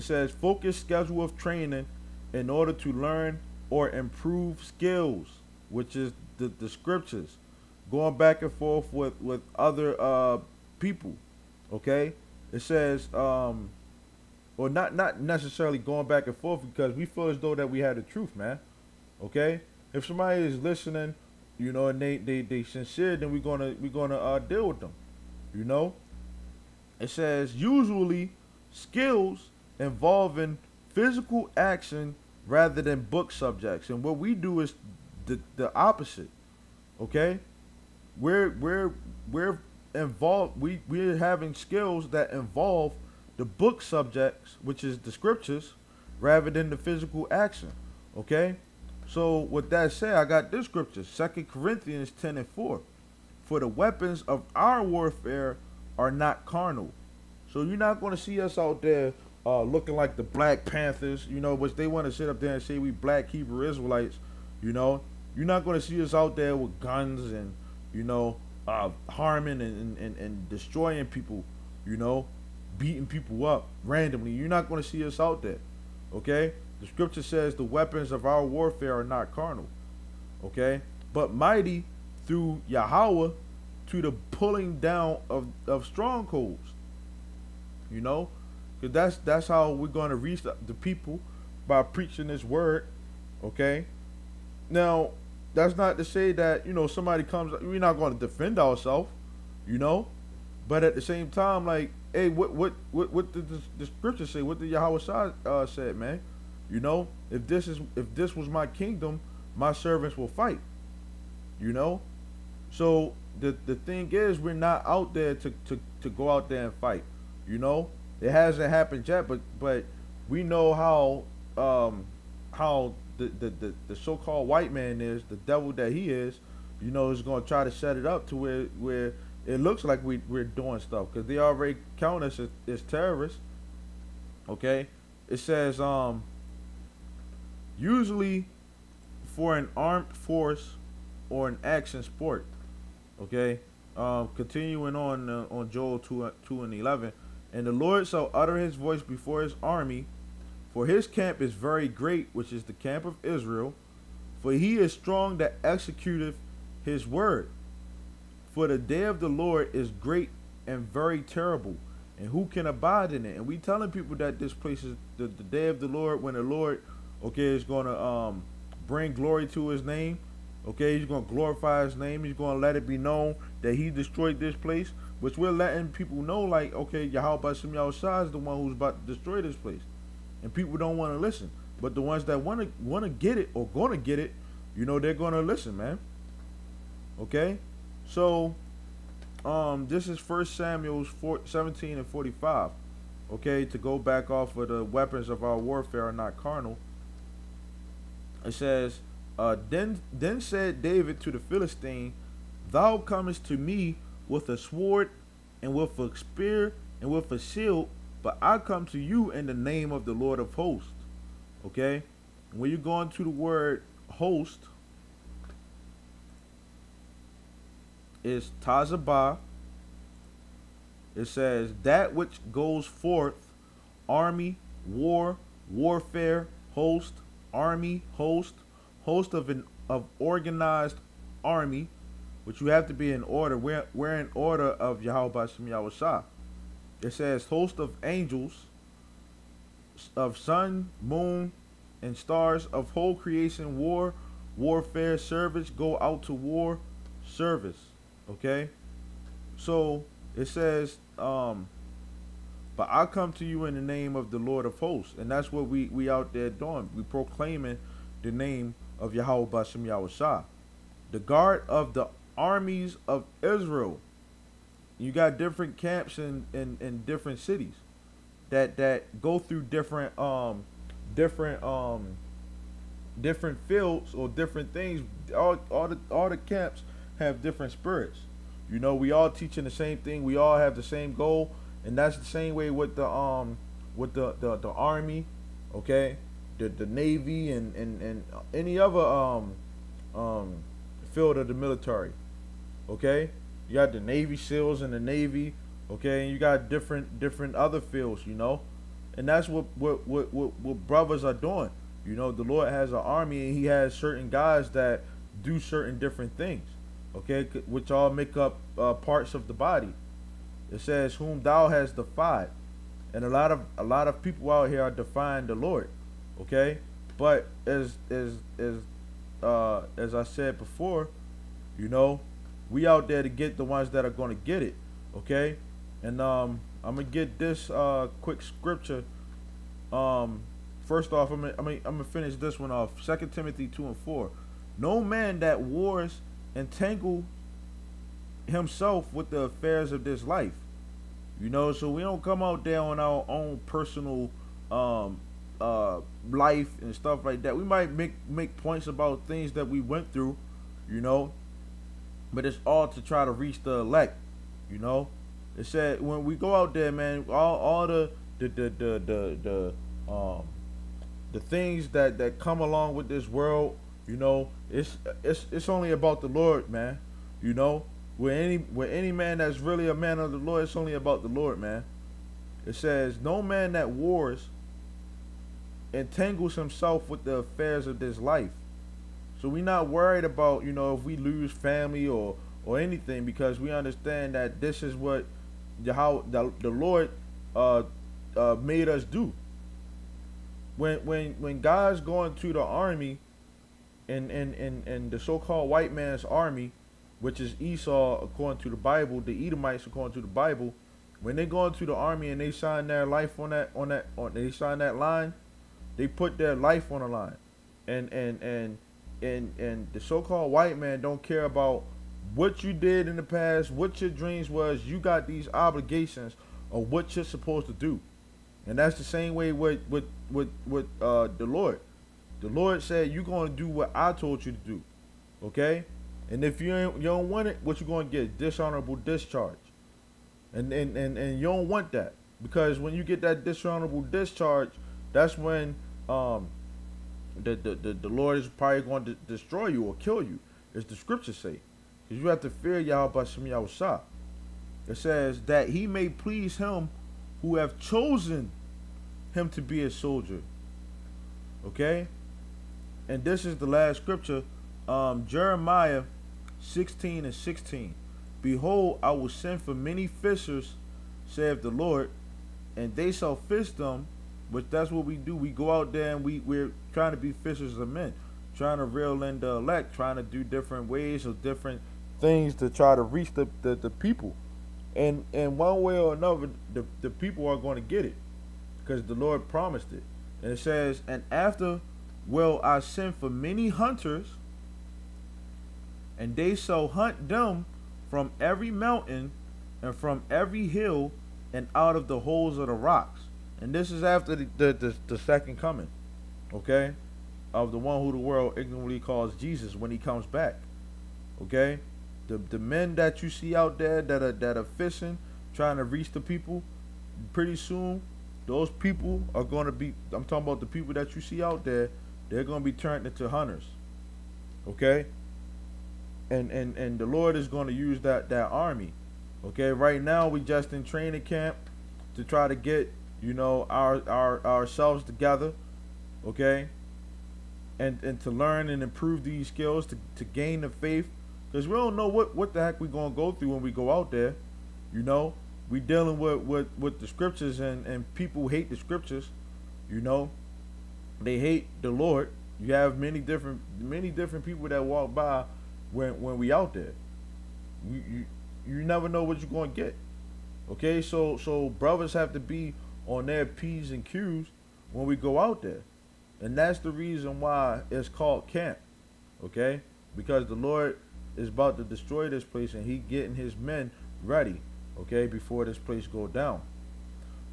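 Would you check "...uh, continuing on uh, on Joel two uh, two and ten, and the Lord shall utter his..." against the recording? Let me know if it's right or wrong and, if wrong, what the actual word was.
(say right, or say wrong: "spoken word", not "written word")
wrong: "eleven", not "ten".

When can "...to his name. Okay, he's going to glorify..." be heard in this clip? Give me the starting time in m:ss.
2:49.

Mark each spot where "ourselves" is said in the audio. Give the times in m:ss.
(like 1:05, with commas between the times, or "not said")
1:38, 8:44.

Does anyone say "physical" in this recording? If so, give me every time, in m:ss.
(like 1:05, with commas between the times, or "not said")
0:30, 0:46.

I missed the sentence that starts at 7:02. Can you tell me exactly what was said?
The Lord said you're gonna do what I told you to do.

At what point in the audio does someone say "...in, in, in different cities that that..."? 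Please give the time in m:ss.
4:26.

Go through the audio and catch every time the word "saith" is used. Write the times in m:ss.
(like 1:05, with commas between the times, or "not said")
7:41.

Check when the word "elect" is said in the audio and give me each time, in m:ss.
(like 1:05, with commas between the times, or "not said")
5:53, 7:49.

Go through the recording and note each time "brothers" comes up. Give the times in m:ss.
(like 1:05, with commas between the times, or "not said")
5:00, 9:11.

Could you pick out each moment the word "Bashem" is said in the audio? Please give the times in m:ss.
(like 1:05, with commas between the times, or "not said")
4:19, 7:23.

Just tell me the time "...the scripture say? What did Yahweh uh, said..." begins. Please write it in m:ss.
1:43.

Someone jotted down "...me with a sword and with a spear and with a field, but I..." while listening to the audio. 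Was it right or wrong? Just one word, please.
wrong.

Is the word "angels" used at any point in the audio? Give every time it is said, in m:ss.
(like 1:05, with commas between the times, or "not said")
3:58.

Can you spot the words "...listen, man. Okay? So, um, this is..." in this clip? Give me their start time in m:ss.
3:05.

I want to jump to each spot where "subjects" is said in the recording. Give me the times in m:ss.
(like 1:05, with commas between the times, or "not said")
0:33, 0:43.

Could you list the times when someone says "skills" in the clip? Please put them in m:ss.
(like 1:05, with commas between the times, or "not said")
0:04, 0:28, 0:41, 8:49.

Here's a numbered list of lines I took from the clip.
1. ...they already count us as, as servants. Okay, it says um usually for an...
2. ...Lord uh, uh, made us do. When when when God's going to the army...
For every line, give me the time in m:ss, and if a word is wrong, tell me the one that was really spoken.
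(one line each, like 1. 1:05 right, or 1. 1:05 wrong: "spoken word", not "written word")
1. 2:11 wrong: "terrorists", not "servants"
2. 6:26 right.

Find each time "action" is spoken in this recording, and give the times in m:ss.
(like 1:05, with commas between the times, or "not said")
0:31, 0:47, 2:21.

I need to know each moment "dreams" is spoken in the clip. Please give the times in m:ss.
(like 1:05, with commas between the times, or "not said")
6:54.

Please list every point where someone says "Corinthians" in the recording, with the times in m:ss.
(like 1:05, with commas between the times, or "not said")
0:51.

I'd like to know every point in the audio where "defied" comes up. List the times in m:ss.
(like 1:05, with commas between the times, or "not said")
5:11.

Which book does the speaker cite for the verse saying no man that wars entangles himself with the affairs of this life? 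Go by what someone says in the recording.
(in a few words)
Second Timothy.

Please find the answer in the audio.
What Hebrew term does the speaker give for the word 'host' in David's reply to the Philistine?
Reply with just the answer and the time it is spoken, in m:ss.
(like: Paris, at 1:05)
Tazabah, at 3:38.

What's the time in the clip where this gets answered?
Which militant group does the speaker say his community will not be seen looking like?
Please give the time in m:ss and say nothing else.
1:00.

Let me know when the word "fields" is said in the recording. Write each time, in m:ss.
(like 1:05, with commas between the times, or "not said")
4:33, 4:51, 4:57.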